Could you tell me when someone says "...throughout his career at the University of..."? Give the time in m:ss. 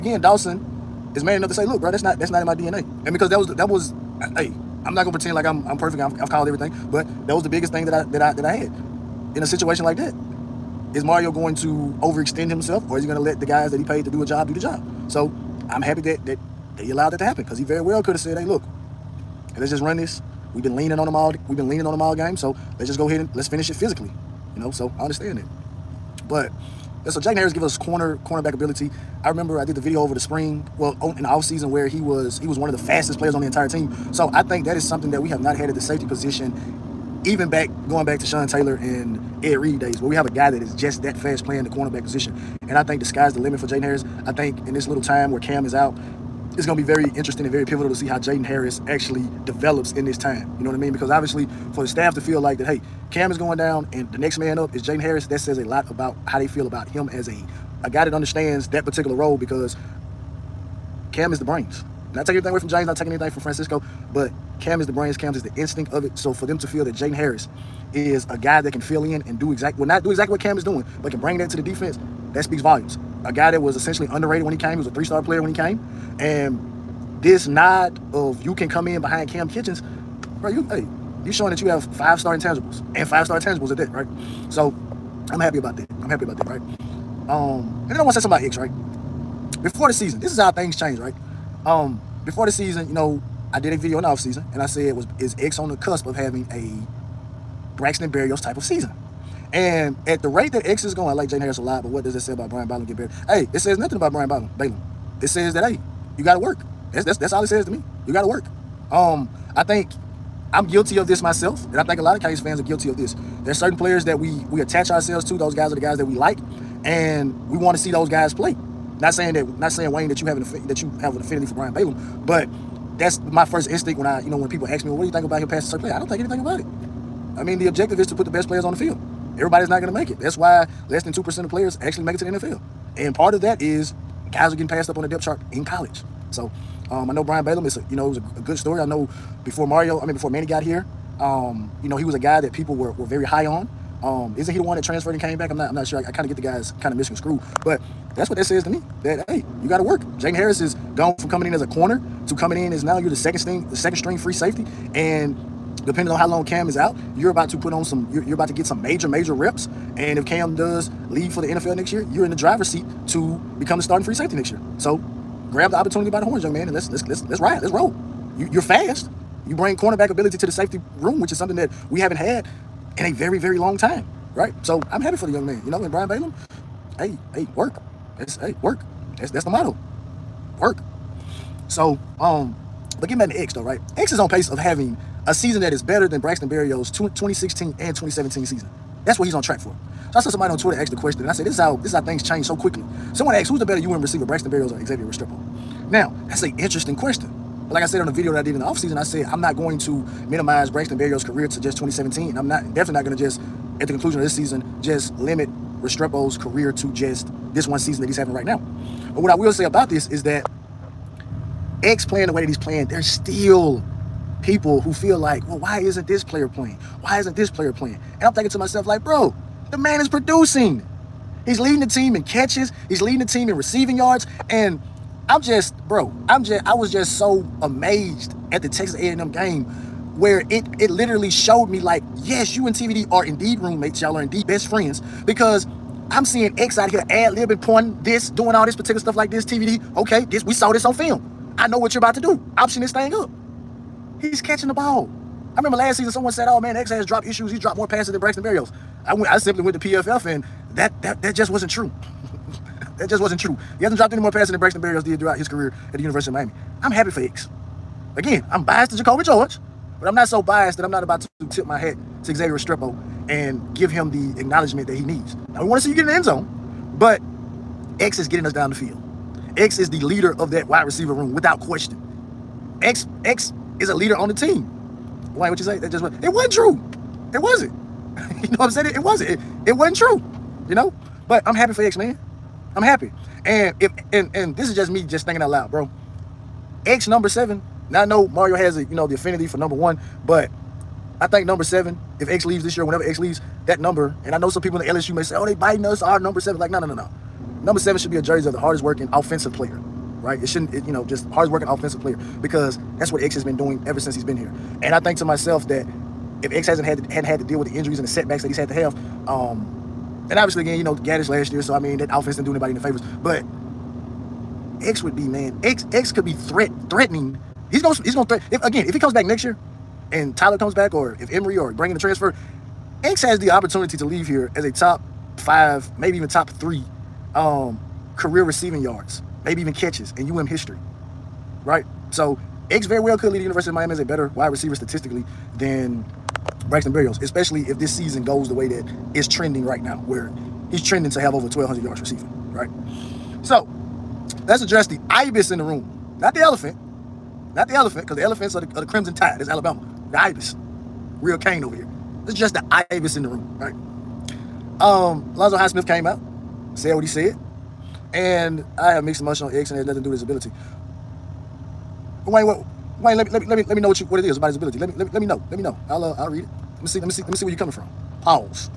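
4:15.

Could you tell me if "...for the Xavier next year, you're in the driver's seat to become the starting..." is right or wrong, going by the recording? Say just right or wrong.
wrong.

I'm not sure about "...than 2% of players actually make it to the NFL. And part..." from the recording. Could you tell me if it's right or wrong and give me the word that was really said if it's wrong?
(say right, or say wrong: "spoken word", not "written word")
right.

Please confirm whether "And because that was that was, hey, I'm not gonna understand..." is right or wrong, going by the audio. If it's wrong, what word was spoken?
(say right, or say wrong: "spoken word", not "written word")
wrong: "pretend", not "understand".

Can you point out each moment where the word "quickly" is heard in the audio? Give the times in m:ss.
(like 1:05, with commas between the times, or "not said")
3:12.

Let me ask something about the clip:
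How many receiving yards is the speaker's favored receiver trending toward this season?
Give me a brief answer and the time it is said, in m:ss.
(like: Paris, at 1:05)
1,200, at 5:41.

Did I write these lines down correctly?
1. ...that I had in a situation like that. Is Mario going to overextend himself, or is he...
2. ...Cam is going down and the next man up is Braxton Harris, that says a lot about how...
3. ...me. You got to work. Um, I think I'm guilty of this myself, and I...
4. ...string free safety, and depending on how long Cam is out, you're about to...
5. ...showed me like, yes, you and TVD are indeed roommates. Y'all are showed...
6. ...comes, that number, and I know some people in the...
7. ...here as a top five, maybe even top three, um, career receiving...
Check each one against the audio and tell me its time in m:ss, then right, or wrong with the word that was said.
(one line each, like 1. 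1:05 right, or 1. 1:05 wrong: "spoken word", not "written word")
1. 0:08 right
2. 0:53 wrong: "Jaden", not "Braxton"
3. 1:47 right
4. 2:33 right
5. 3:51 wrong: "indeed", not "showed"
6. 4:53 wrong: "leaves", not "comes"
7. 5:24 right.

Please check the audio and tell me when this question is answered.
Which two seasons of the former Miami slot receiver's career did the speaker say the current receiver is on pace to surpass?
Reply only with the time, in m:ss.
3:06.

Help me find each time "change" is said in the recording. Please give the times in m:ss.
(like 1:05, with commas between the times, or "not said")
1:30, 3:12.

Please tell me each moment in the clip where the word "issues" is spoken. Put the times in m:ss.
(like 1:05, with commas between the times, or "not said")
4:07.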